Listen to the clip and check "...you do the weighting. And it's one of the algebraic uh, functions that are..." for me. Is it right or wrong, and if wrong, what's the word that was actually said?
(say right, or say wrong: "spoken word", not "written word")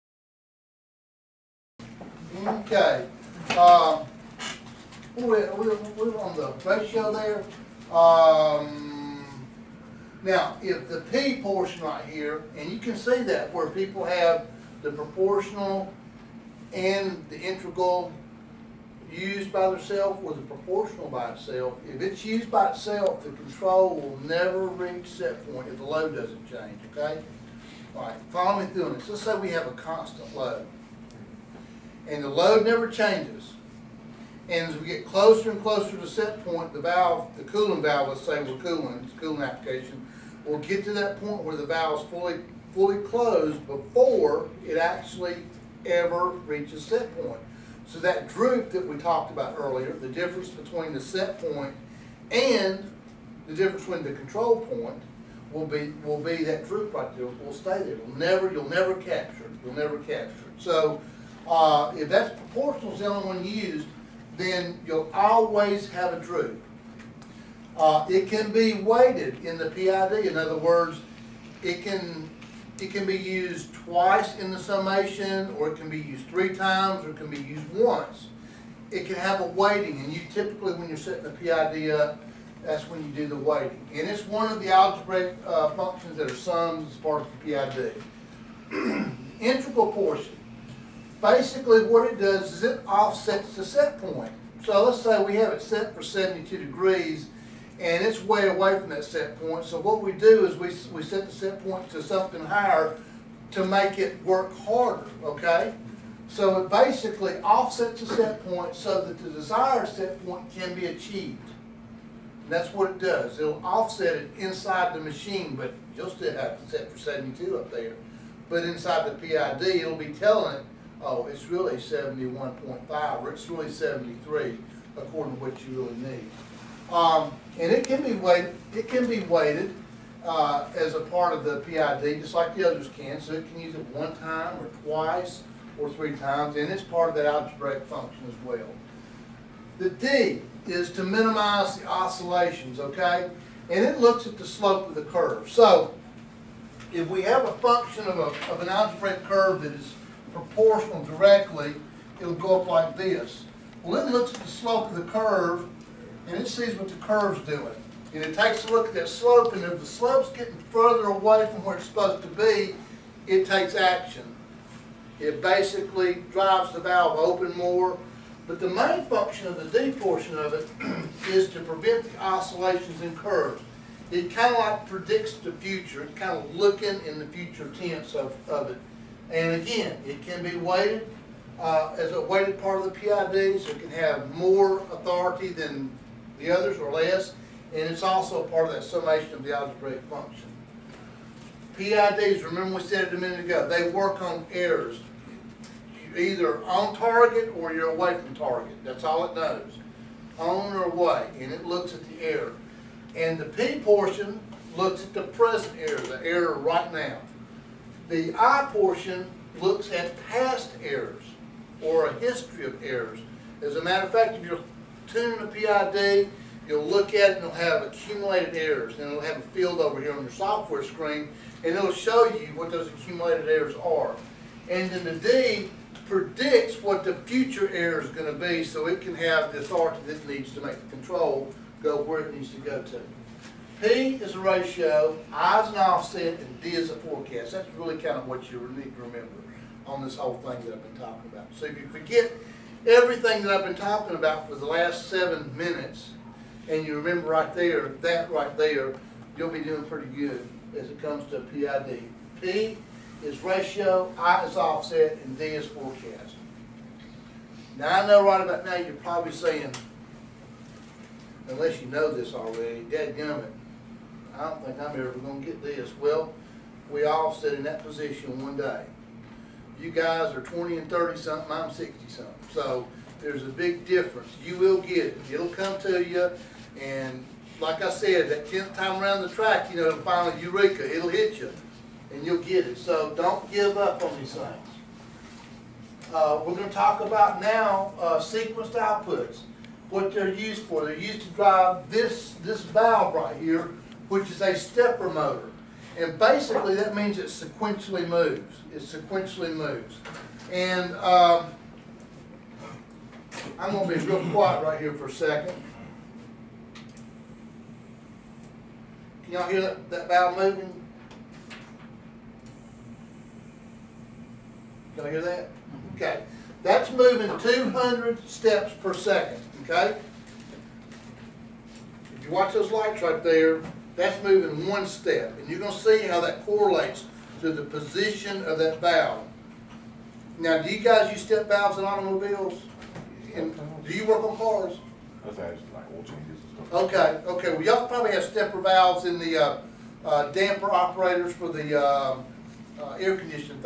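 right.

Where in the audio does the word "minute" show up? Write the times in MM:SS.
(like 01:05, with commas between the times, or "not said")
03:13, 04:05.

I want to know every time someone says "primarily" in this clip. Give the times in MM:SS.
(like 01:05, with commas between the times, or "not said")
not said.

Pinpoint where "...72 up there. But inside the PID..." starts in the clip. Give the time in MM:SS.
01:56.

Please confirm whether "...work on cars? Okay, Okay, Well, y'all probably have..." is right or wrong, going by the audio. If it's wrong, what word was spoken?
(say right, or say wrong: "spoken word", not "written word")
right.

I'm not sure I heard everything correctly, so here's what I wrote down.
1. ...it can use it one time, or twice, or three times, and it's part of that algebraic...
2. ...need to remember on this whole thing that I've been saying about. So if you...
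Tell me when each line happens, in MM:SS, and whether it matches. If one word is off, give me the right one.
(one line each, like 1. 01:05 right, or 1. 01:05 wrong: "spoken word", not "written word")
1. 02:13 right
2. 03:58 wrong: "talking", not "saying".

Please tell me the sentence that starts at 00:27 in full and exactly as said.
All right, follow me through this.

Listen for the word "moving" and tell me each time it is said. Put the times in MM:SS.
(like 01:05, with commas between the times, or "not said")
05:10, 05:16, 05:24.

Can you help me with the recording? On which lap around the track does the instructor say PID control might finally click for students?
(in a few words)
tenth.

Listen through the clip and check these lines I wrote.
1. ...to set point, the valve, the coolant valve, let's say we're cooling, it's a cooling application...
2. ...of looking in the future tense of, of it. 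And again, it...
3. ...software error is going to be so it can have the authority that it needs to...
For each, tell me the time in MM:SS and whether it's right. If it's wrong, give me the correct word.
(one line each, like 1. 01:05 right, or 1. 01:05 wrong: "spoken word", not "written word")
1. 00:35 right
2. 02:56 right
3. 03:47 wrong: "future", not "software".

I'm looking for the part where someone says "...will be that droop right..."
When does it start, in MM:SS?
00:56.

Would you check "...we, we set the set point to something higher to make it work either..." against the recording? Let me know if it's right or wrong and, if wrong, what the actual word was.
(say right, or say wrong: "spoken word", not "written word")
wrong: "harder", not "either".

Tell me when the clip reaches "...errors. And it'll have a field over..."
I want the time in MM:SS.
03:38.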